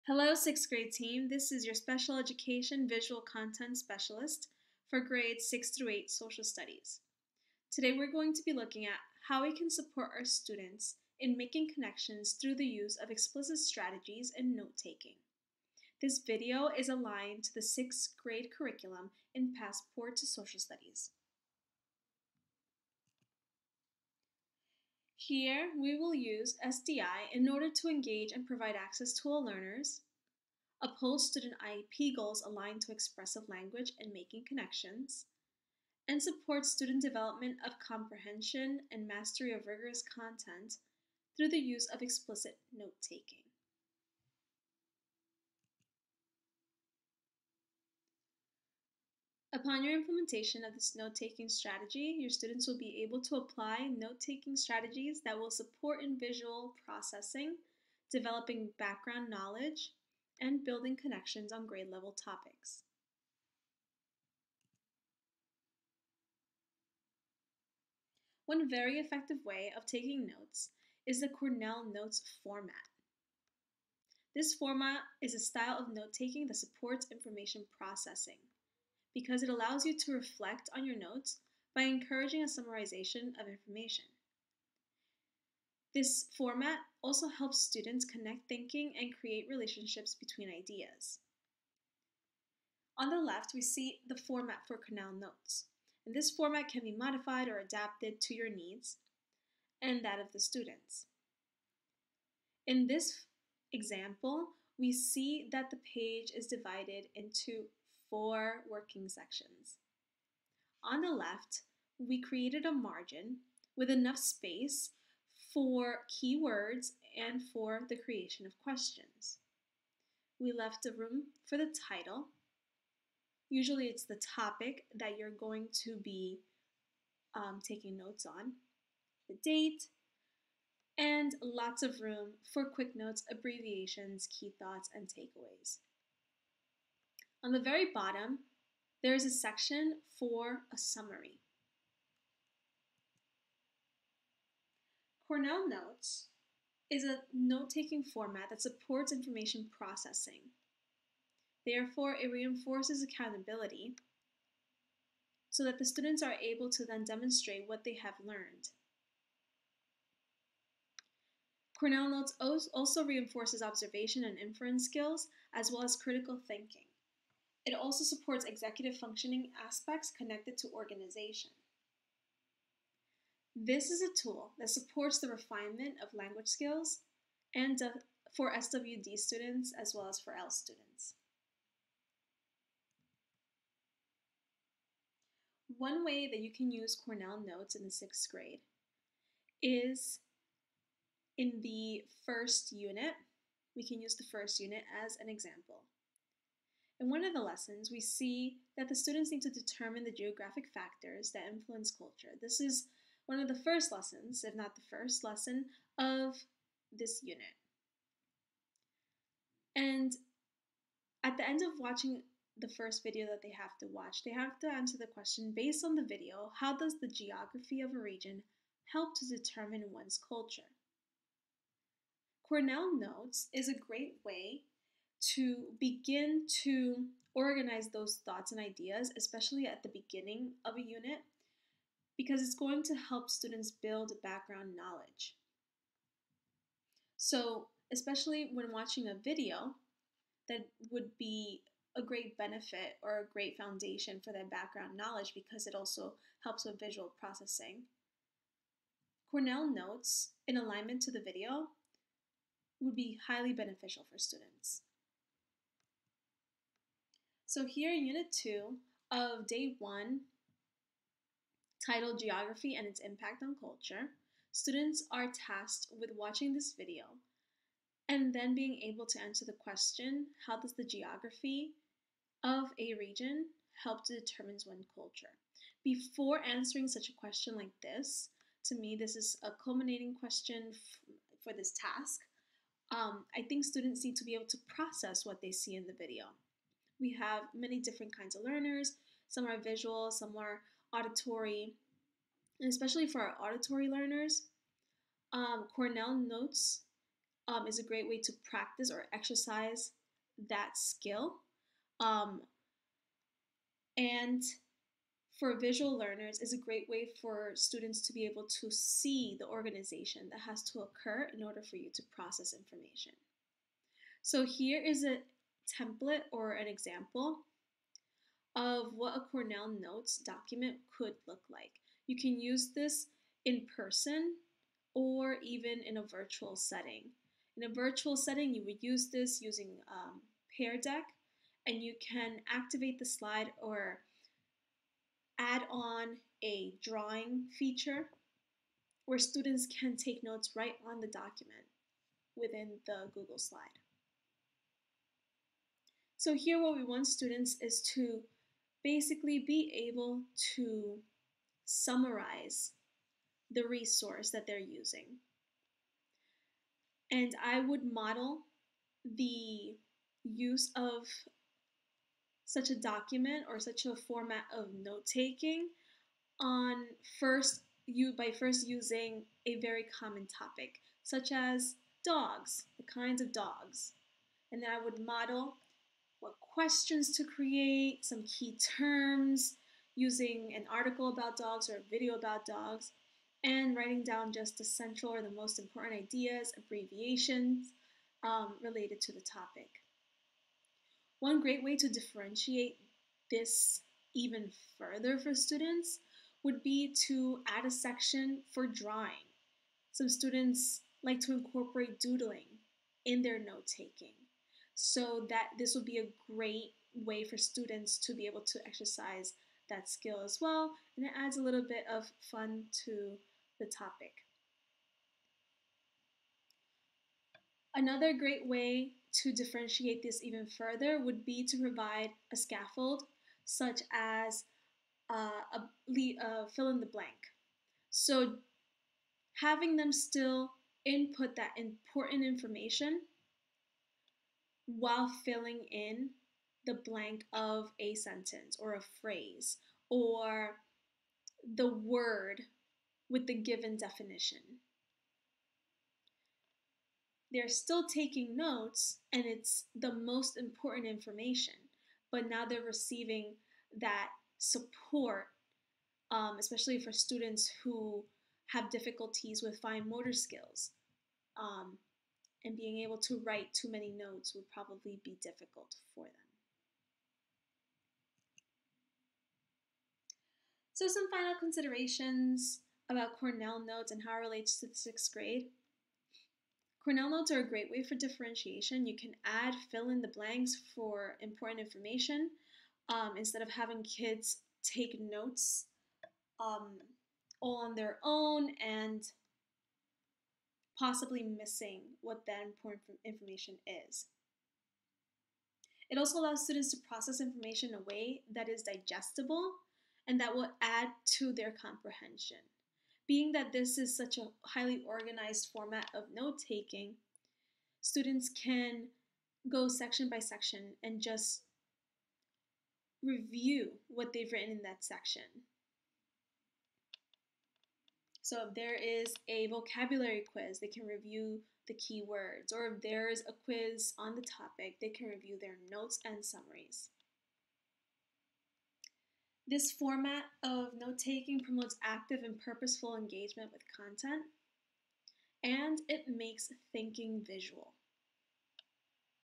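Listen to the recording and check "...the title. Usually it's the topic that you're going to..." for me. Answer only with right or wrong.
right.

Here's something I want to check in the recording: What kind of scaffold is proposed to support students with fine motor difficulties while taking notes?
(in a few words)
Fill in the blank.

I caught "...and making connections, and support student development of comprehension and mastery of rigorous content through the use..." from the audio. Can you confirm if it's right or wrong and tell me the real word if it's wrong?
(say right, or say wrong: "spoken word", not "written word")
right.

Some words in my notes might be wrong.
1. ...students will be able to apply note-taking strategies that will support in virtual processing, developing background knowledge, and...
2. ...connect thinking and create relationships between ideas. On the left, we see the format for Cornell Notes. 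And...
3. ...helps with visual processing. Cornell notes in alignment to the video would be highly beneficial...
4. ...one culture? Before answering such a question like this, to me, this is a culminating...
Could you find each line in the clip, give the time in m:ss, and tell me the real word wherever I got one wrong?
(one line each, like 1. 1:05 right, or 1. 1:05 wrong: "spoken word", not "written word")
1. 0:52 wrong: "visual", not "virtual"
2. 1:28 right
3. 4:06 right
4. 4:34 right.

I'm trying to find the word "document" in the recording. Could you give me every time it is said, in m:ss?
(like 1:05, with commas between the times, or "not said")
5:20, 5:41, 6:02.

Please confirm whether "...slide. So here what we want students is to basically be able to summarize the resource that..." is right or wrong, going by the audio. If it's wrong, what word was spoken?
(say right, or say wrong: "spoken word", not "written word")
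right.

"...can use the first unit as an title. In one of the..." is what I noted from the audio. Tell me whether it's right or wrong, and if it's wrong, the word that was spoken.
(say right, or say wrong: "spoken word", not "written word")
wrong: "example", not "title".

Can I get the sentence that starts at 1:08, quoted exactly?
One very effective way of taking notes is the Cornell Notes format.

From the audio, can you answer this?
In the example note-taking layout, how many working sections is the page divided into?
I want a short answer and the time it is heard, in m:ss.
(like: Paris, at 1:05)
4, at 1:48.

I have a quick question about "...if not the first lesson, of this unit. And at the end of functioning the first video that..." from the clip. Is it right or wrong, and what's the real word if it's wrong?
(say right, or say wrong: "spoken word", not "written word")
wrong: "watching", not "functioning".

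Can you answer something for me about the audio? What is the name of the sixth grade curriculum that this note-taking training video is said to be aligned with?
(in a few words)
Passport to Social Studies.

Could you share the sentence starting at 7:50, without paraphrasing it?
So some final considerations about Cornell notes and how it relates to the sixth grade.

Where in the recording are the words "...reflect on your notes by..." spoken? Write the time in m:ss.
1:20.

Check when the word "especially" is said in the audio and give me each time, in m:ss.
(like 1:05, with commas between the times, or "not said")
3:49, 3:57, 4:52, 7:36.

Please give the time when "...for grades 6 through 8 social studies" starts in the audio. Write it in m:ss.
0:04.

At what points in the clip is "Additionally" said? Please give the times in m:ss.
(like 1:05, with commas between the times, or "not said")
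not said.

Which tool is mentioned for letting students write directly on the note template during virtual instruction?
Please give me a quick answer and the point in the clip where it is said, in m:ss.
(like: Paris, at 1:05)
Pear Deck, at 5:30.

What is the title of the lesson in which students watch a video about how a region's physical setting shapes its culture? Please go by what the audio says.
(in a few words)
Geography and its Impact on Culture.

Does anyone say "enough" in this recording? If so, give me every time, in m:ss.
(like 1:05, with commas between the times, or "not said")
1:53.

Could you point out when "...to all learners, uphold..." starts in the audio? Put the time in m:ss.
0:29.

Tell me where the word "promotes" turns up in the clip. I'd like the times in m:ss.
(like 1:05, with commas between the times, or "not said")
8:51.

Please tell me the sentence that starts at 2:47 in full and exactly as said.
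It also supports executive functioning aspects connected to organization.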